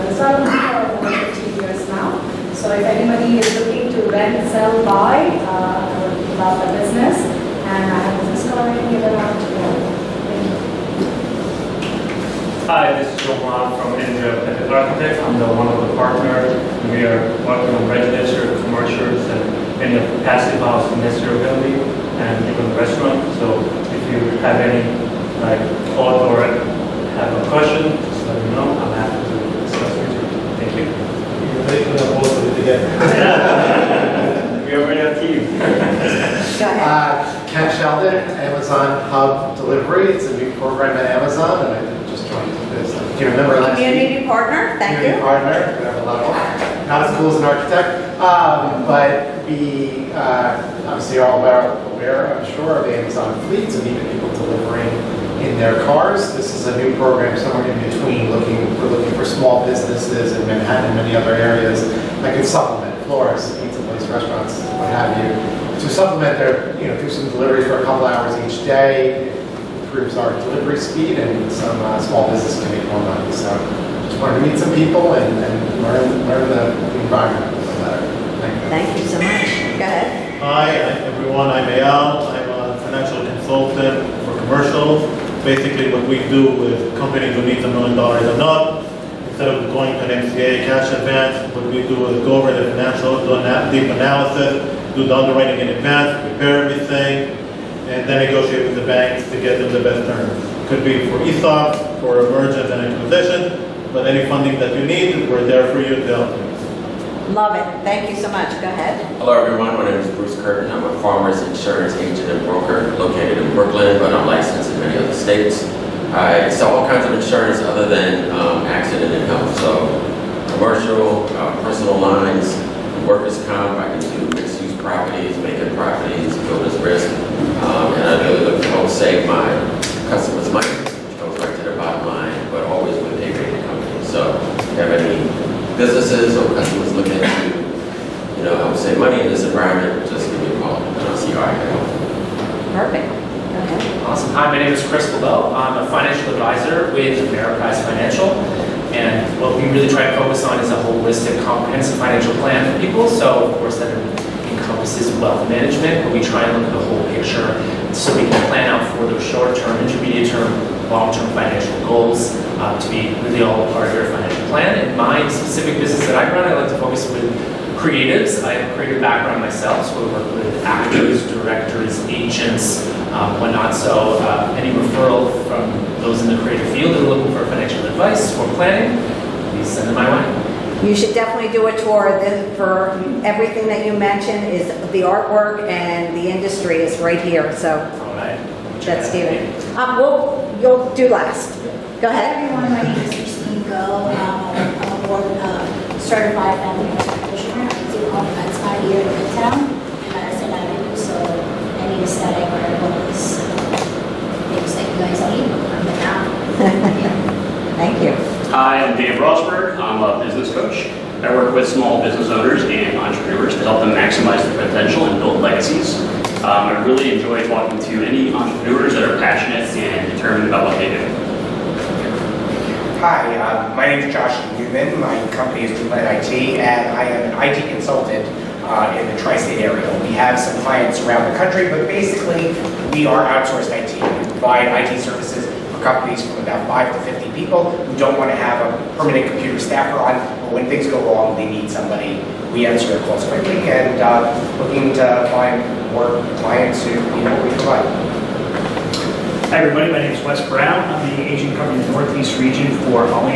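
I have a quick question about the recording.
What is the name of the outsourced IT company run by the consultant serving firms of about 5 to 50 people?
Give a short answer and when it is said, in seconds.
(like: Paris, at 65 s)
Moonlight IT, at 225 s.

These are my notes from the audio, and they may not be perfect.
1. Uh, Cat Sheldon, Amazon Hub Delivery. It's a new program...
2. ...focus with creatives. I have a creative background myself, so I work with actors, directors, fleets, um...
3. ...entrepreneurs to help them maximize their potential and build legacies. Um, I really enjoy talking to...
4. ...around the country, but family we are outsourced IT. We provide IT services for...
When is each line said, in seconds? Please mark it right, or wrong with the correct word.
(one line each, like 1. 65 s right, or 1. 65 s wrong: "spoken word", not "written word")
1. 35 s right
2. 166 s wrong: "agents", not "fleets"
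3. 212 s right
4. 231 s wrong: "basically", not "family".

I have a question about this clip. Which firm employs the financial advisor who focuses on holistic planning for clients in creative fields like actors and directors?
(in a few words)
Ameriprise Financial.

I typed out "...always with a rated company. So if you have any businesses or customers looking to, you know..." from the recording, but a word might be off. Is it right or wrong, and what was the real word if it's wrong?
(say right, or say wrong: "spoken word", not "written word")
right.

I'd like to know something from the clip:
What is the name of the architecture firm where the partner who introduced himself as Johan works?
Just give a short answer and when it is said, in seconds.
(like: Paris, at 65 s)
Andrea Pettit Architects, at 13 s.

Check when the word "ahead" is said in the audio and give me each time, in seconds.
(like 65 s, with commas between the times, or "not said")
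79 s, 108 s, 192 s.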